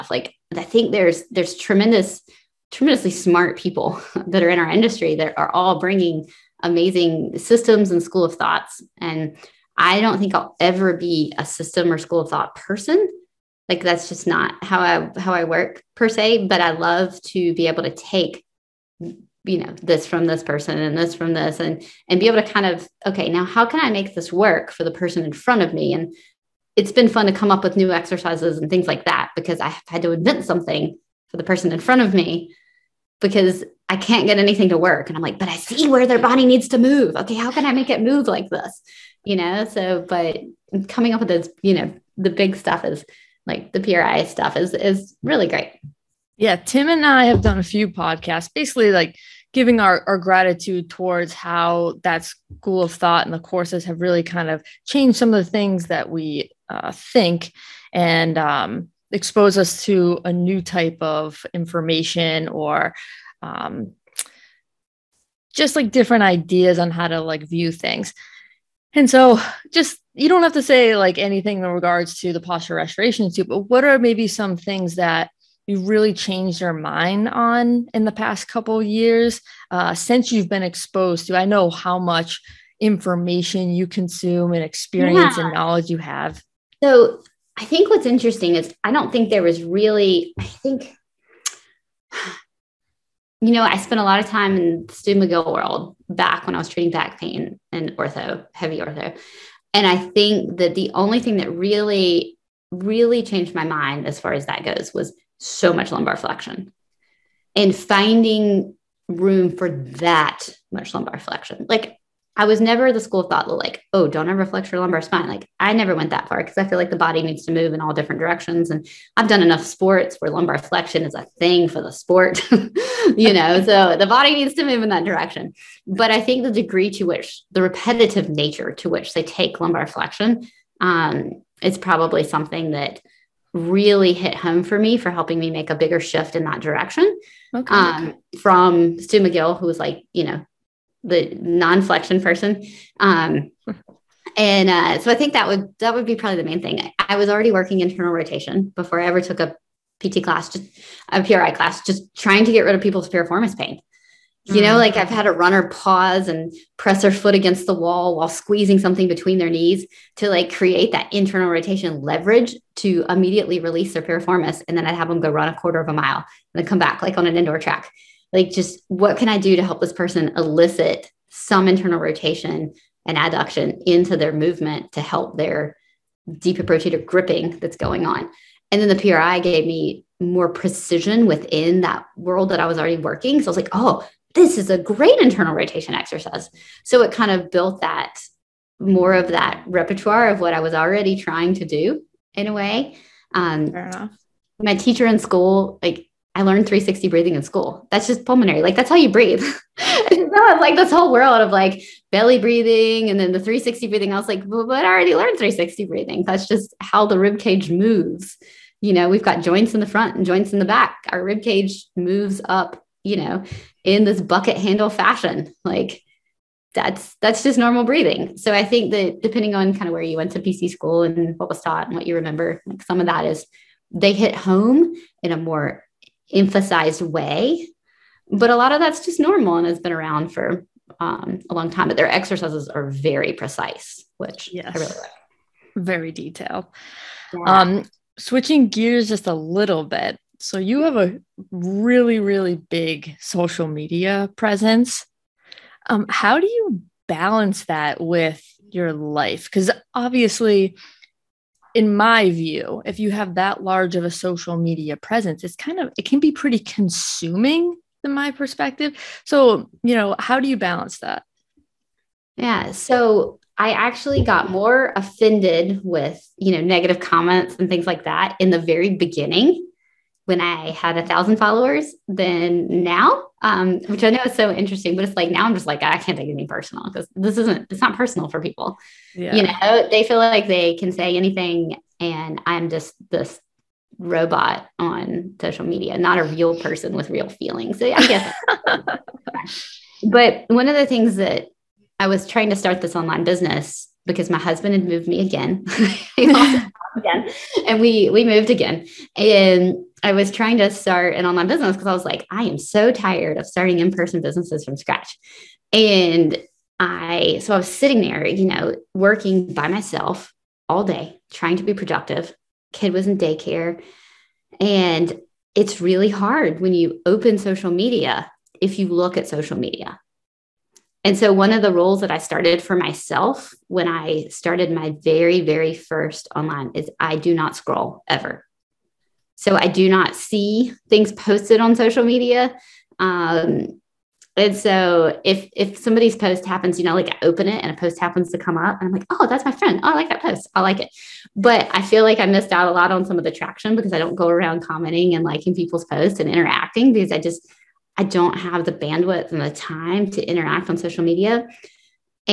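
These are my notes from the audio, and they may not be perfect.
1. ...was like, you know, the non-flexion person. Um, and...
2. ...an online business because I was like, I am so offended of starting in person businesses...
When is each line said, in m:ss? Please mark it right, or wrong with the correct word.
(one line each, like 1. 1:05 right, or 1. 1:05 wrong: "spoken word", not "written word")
1. 2:19 right
2. 5:01 wrong: "tired", not "offended".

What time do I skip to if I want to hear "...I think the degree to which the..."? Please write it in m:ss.
2:06.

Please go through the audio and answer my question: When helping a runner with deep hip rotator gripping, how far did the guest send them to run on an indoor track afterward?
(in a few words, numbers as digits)
a quarter of a mile.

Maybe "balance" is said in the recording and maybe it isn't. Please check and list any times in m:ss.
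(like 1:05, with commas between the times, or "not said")
4:07, 4:20.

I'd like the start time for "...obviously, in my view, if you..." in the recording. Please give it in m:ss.
4:09.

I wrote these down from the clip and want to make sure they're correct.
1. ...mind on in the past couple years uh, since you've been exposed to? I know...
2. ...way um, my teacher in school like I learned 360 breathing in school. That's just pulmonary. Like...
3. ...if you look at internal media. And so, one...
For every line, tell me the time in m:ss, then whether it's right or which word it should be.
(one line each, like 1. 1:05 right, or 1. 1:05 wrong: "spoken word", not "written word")
1. 1:16 right
2. 3:12 right
3. 5:18 wrong: "social", not "internal".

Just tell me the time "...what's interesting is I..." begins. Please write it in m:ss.
1:27.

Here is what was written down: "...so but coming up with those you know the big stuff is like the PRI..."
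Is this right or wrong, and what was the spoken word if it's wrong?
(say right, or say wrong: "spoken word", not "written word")
right.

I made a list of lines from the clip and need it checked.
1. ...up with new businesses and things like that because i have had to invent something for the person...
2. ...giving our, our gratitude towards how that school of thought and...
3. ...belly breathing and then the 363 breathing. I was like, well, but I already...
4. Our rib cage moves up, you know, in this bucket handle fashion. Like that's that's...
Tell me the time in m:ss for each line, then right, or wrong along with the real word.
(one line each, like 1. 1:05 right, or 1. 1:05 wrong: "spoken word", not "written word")
1. 0:27 wrong: "exercises", not "businesses"
2. 0:49 right
3. 3:22 wrong: "360", not "363"
4. 3:31 right.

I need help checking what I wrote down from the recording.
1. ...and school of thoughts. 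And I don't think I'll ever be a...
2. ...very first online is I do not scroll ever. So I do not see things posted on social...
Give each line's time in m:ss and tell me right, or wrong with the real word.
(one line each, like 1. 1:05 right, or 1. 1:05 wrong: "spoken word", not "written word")
1. 0:07 right
2. 5:25 right.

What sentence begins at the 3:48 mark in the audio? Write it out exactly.
But a lot of that's just normal and has been around for um, a long time.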